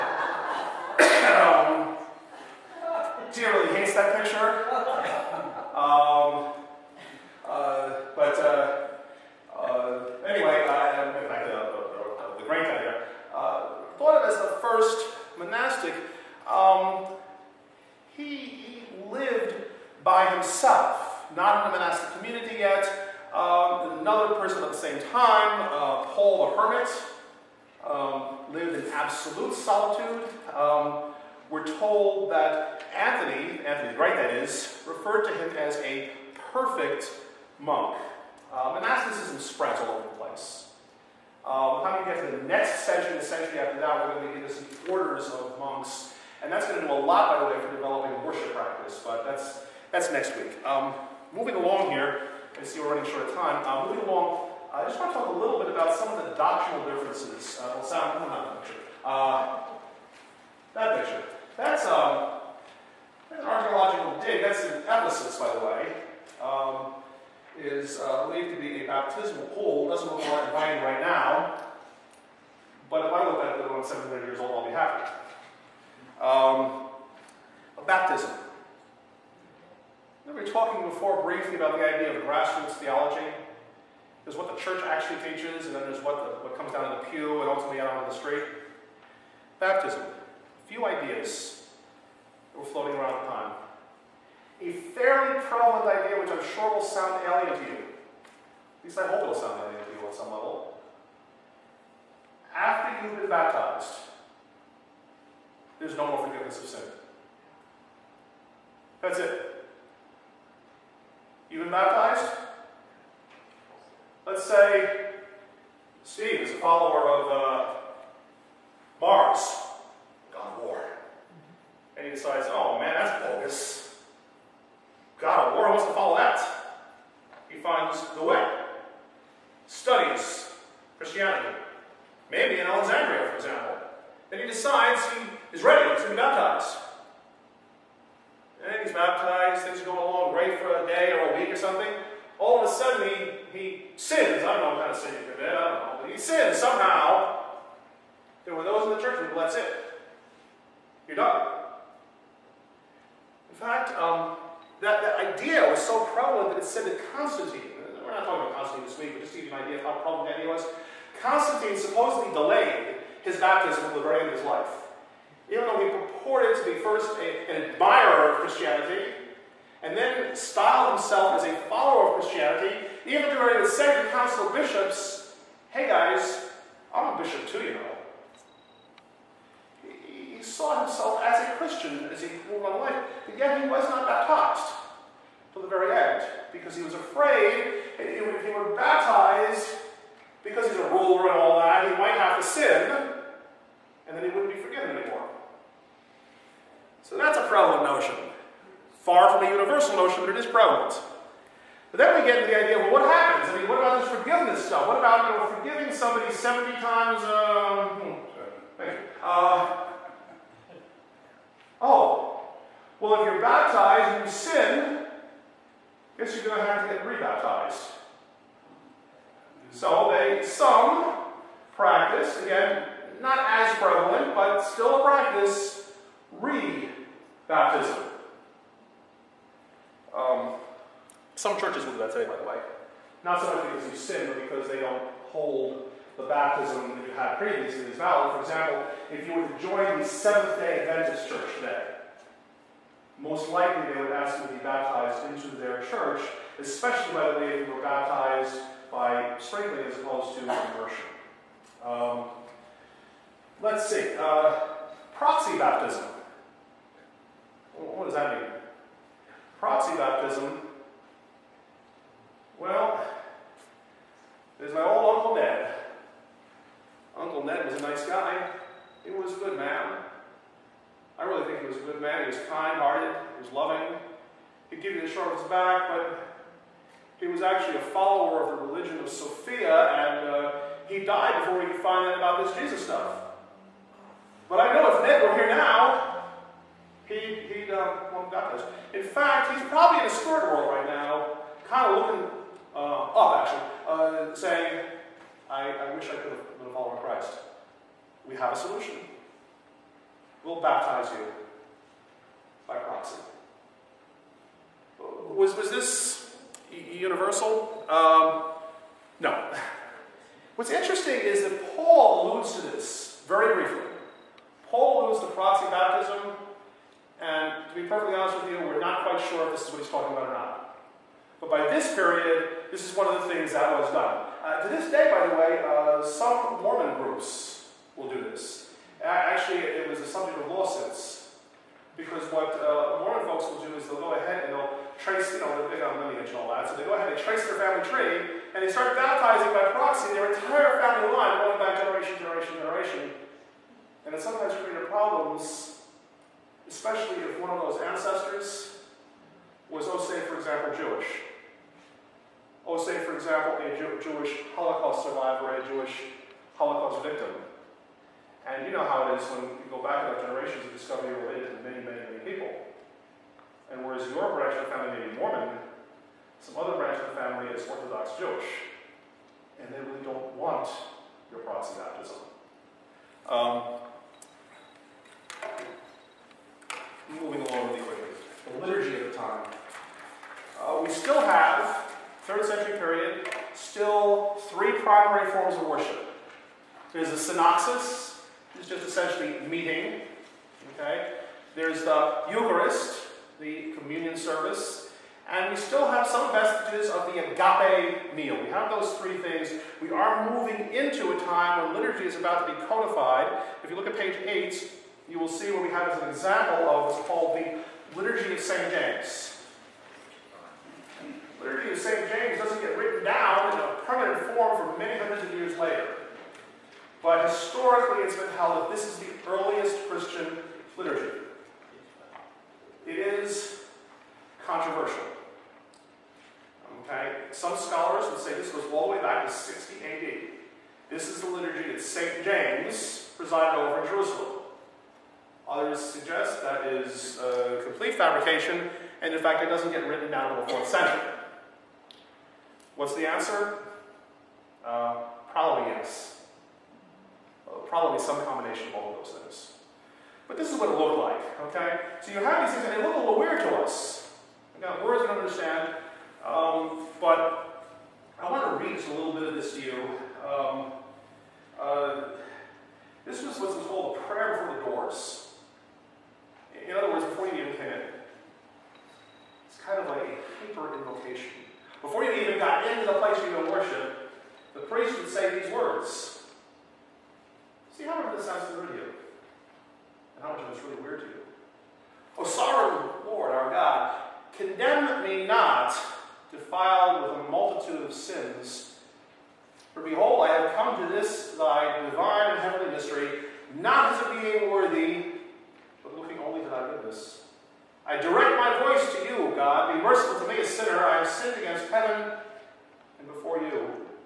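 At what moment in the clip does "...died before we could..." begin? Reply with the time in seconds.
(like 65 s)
280 s.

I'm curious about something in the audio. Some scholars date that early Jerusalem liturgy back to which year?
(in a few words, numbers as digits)
60 AD.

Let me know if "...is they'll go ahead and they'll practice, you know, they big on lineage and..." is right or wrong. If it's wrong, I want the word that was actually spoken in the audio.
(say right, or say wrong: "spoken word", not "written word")
wrong: "trace", not "practice".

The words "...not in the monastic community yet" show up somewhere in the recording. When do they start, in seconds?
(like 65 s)
21 s.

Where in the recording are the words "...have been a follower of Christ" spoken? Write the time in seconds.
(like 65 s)
296 s.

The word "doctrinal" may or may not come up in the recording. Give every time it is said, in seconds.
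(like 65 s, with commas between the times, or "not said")
56 s.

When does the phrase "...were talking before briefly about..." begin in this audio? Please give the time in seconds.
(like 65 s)
80 s.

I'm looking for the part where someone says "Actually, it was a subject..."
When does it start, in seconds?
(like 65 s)
329 s.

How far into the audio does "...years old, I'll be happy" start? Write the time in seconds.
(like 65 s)
74 s.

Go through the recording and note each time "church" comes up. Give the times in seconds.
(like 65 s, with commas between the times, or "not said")
84 s, 245 s.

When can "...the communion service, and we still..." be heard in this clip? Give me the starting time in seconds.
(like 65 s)
393 s.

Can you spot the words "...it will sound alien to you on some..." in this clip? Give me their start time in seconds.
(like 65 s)
99 s.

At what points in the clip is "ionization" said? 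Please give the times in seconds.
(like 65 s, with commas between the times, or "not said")
not said.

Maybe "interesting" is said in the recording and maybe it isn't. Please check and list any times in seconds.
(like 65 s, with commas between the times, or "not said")
310 s.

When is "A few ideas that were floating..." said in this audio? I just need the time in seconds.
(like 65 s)
89 s.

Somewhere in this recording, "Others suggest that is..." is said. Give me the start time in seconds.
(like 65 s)
435 s.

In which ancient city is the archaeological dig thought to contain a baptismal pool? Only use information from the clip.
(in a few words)
Ephesus.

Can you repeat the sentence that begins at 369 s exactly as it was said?
And they really don't want your proxy baptism.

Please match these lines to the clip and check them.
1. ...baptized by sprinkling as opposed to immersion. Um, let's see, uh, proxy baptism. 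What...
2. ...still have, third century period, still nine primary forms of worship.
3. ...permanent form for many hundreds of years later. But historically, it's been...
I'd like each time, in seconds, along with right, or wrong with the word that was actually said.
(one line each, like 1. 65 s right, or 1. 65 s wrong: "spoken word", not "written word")
1. 247 s right
2. 380 s wrong: "three", not "nine"
3. 413 s right.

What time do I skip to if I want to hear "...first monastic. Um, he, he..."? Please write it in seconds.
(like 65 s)
14 s.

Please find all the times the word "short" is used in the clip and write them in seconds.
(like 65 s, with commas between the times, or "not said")
53 s, 275 s.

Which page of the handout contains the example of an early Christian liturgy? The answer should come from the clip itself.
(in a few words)
8.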